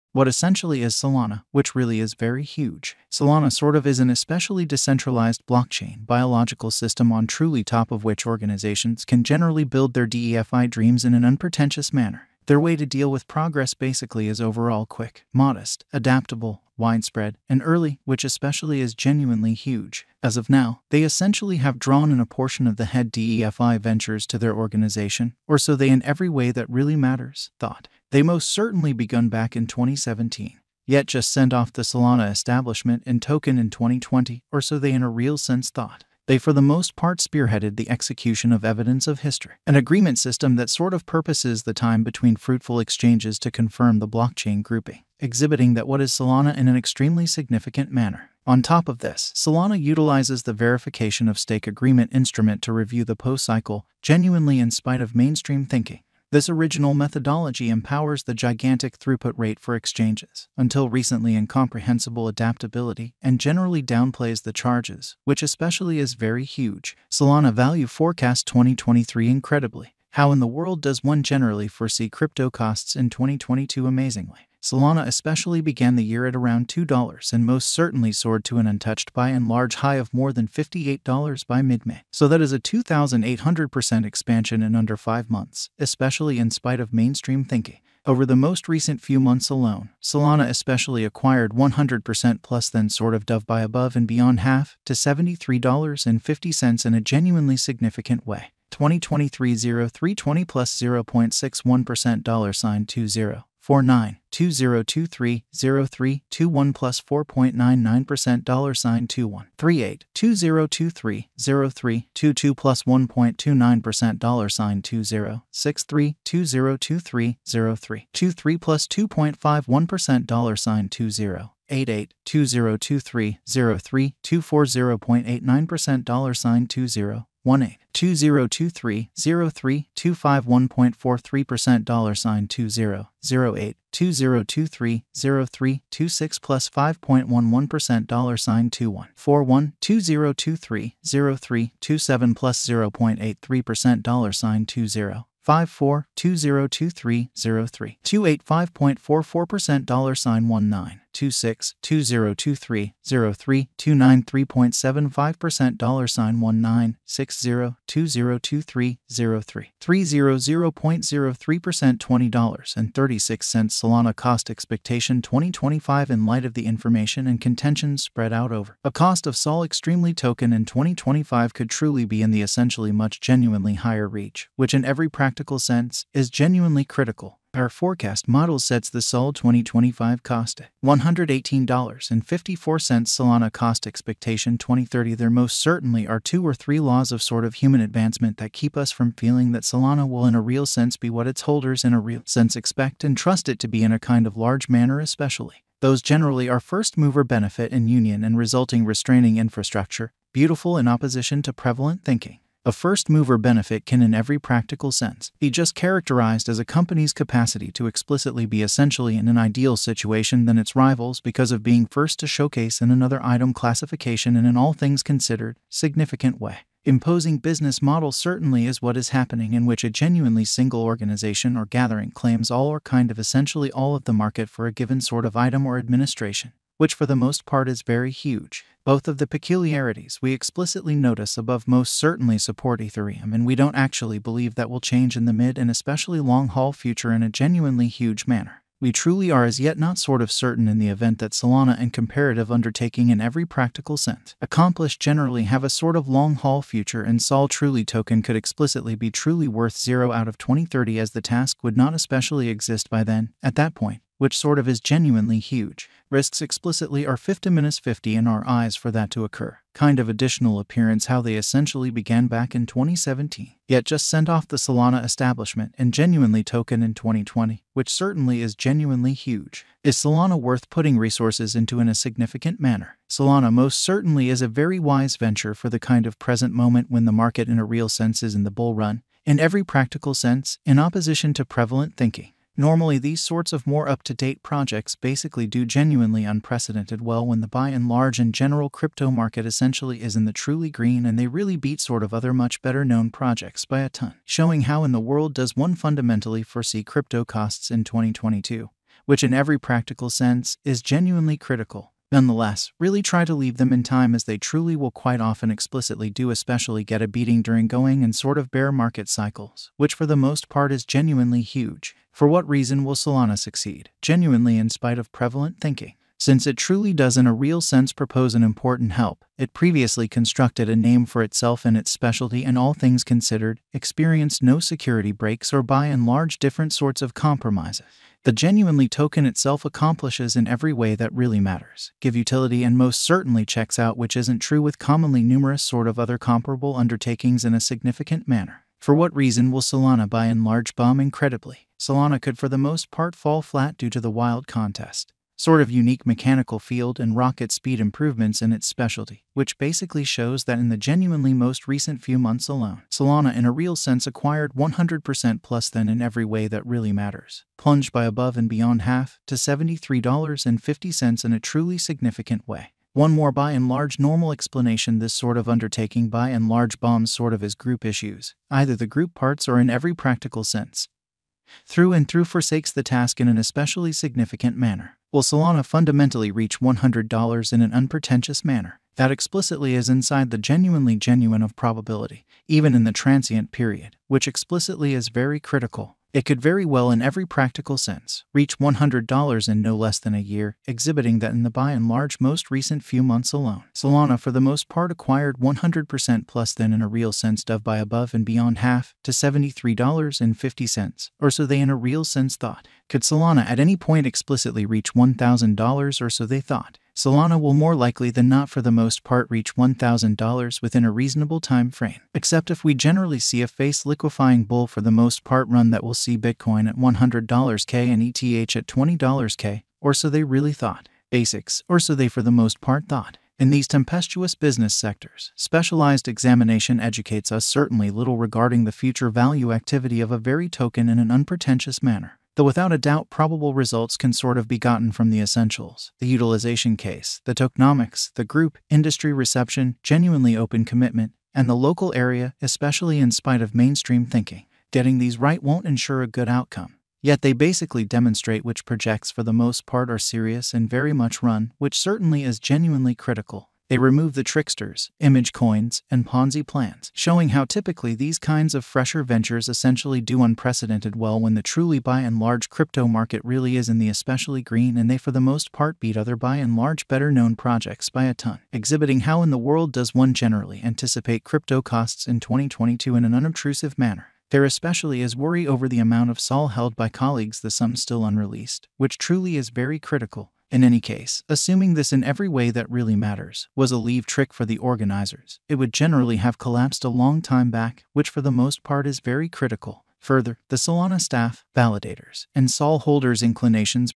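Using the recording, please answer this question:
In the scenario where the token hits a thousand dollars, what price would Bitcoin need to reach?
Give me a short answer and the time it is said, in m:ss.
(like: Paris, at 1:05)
$100k, at 6:56.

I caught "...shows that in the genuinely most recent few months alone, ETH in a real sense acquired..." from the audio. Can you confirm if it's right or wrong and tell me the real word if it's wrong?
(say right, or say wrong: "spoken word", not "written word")
wrong: "Solana", not "ETH".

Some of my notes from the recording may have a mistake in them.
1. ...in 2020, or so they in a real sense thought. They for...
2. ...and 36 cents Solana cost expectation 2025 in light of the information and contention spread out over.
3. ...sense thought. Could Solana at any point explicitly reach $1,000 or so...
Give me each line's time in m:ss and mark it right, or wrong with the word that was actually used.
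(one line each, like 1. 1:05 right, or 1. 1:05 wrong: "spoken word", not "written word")
1. 0:33 right
2. 2:42 right
3. 6:42 right.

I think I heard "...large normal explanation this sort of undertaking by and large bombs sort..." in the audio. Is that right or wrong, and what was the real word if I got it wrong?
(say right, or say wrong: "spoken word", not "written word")
right.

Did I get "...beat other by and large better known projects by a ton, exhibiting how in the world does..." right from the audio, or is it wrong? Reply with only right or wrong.
right.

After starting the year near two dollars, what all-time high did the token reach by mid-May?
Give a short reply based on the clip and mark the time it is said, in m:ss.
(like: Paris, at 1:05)
$58, at 1:20.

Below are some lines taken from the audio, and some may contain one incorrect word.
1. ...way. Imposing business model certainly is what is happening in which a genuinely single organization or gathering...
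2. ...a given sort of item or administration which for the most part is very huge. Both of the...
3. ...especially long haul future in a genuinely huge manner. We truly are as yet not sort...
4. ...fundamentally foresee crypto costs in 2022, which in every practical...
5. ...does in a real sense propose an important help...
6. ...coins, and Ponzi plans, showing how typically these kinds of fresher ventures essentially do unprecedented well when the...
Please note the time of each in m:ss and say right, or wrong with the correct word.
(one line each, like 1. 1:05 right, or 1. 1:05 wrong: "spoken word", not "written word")
1. 3:36 right
2. 3:44 right
3. 3:55 right
4. 4:55 right
5. 5:16 right
6. 7:35 right.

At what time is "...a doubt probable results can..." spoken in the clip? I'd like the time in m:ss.
7:12.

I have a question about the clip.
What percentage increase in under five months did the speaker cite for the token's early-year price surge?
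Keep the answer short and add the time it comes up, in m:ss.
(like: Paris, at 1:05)
2,800%, at 1:22.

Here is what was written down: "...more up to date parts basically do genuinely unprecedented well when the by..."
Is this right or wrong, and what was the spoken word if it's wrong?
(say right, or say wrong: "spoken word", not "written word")
wrong: "projects", not "parts".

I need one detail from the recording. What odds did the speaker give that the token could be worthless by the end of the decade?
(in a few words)
50/50.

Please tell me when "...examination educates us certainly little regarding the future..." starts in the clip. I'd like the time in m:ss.
7:06.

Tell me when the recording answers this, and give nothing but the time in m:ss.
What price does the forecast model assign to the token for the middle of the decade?
3:00.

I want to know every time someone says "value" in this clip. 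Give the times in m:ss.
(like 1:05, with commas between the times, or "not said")
1:07, 7:09.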